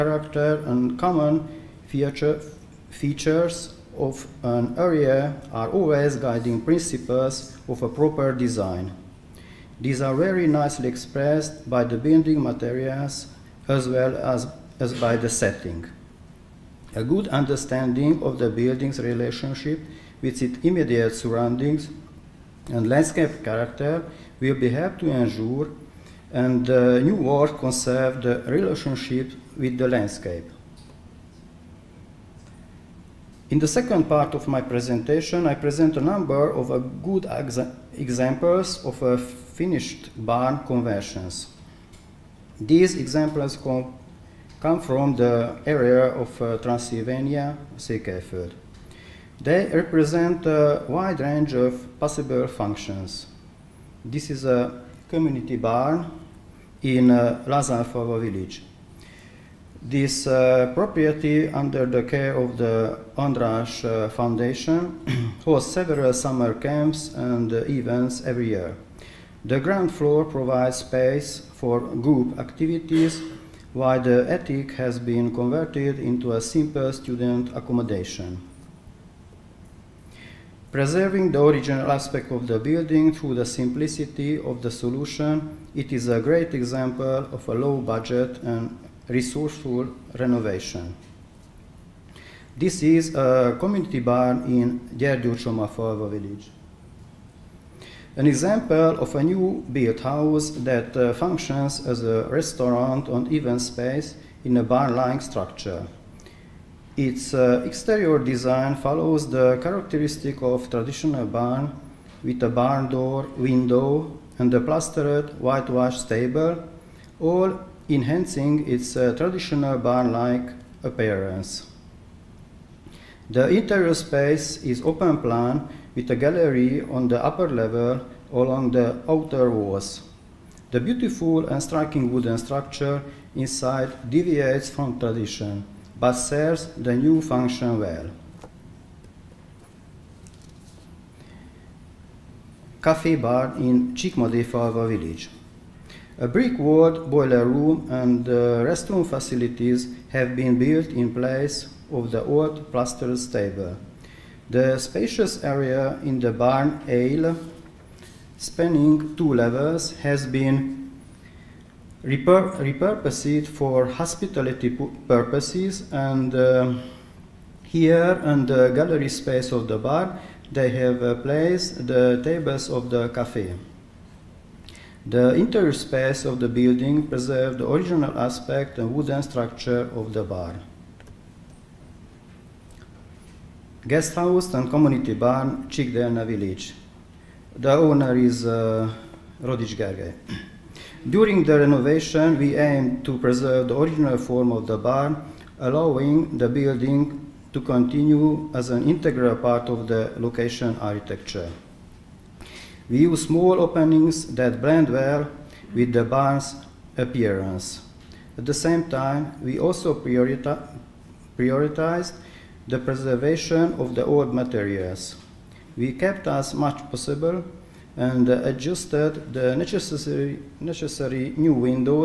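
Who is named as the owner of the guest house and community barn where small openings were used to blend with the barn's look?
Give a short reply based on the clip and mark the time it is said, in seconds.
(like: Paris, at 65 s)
Rodic Gergely, at 189 s.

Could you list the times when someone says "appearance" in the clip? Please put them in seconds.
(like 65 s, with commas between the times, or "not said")
120 s, 206 s.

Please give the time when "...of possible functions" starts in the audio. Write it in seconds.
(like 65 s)
51 s.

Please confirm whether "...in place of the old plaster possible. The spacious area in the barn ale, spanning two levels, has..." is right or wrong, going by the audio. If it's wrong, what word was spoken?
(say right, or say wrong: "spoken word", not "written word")
wrong: "stable", not "possible".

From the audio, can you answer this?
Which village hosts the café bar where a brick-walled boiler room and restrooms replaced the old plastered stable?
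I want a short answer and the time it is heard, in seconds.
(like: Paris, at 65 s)
Csíkmadéfalva, at 143 s.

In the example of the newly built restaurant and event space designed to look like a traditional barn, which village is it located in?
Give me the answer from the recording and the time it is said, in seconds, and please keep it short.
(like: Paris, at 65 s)
Gyergyócsoma Falva, at 94 s.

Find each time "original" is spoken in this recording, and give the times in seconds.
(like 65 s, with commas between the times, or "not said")
81 s, 177 s, 193 s.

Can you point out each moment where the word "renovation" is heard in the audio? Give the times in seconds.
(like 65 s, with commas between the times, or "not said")
90 s, 191 s.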